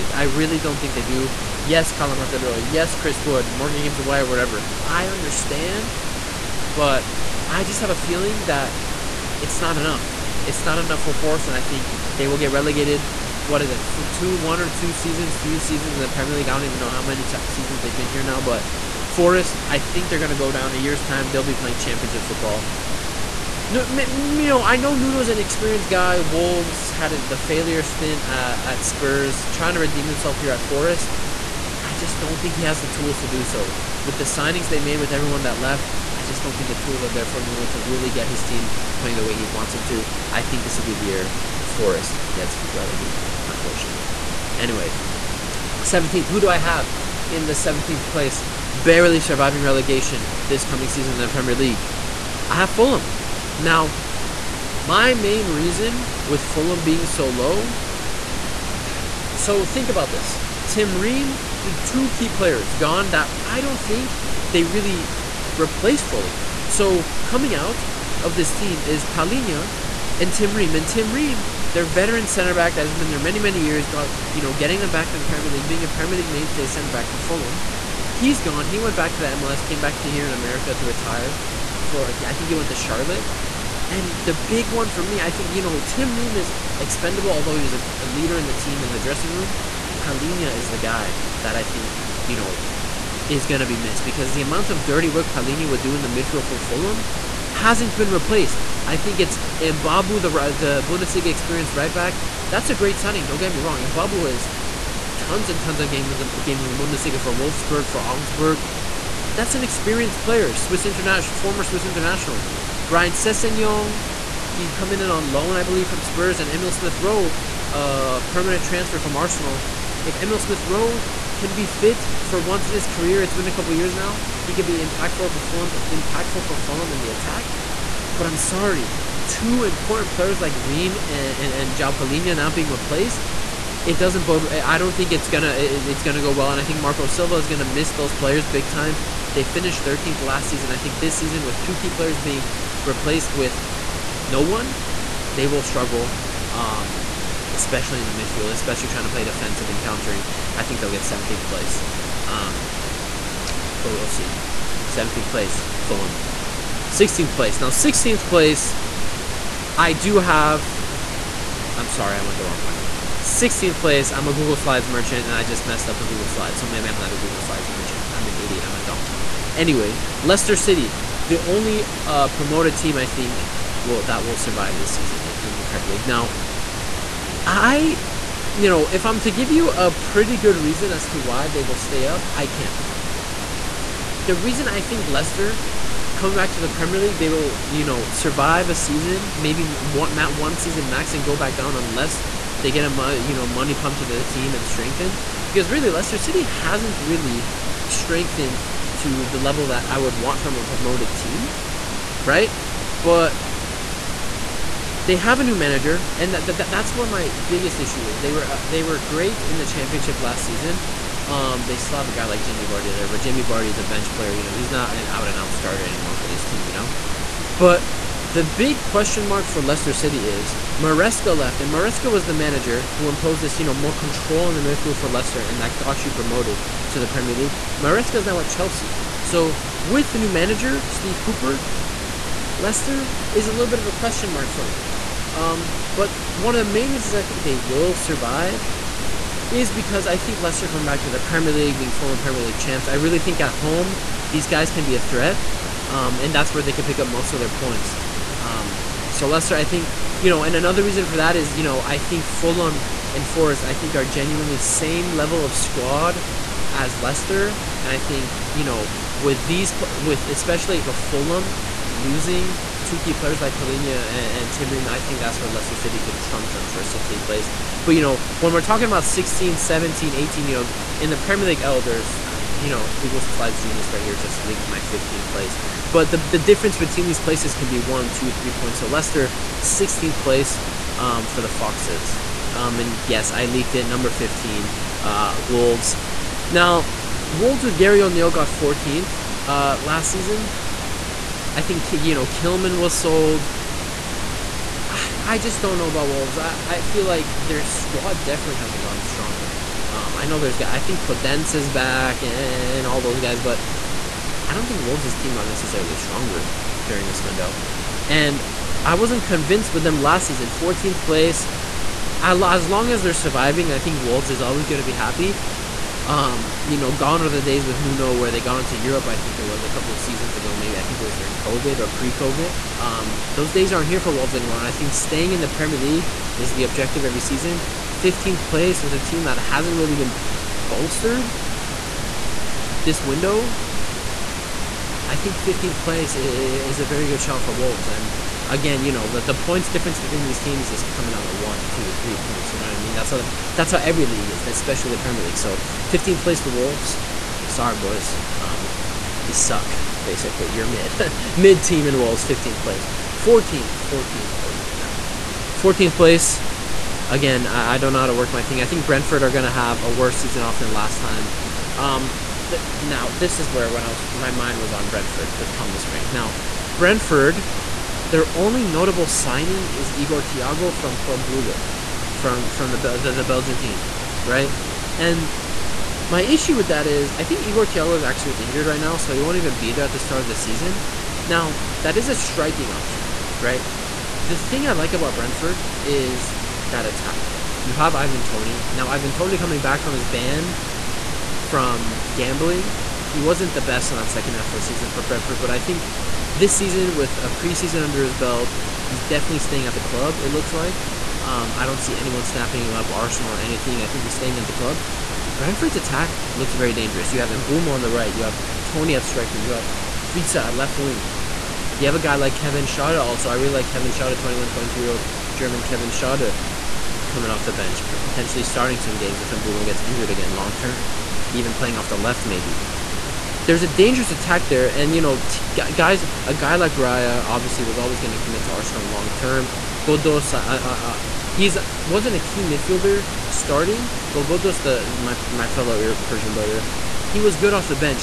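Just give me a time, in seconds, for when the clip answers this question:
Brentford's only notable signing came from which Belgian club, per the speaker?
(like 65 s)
370 s.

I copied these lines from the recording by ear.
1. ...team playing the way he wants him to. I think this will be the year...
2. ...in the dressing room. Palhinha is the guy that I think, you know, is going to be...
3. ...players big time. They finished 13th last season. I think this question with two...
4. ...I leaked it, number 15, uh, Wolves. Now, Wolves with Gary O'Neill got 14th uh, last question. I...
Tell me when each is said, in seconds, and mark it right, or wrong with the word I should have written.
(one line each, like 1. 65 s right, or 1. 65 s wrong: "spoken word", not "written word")
1. 38 s right
2. 88 s right
3. 138 s wrong: "season", not "question"
4. 283 s wrong: "season", not "question".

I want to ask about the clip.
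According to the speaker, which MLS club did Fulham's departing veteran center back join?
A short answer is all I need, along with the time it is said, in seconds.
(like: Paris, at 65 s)
Charlotte, at 82 s.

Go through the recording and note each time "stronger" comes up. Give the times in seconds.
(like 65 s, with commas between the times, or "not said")
299 s, 305 s.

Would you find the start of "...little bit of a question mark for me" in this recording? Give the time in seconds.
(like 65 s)
233 s.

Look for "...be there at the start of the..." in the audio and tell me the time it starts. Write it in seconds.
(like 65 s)
379 s.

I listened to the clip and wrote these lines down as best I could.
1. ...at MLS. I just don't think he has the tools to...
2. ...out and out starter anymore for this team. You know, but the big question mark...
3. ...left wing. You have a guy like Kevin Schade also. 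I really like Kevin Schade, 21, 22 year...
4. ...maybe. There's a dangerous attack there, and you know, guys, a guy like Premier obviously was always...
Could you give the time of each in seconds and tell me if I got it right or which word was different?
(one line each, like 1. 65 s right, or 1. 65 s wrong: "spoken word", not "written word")
1. 30 s wrong: "Forest", not "MLS"
2. 215 s right
3. 410 s right
4. 422 s wrong: "Raya", not "Premier".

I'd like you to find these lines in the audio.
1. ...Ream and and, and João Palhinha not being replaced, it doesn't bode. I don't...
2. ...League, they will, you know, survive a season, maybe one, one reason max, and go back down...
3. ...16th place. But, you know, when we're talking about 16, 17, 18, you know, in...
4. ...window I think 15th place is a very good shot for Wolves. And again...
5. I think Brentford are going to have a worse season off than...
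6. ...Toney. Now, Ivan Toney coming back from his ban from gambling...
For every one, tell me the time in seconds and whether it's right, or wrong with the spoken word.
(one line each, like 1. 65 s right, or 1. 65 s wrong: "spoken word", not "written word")
1. 130 s right
2. 186 s wrong: "season", not "reason"
3. 266 s right
4. 333 s right
5. 358 s right
6. 388 s right.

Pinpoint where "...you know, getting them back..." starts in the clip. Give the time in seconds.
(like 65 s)
74 s.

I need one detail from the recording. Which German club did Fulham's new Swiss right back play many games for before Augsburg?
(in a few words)
Wolfsburg.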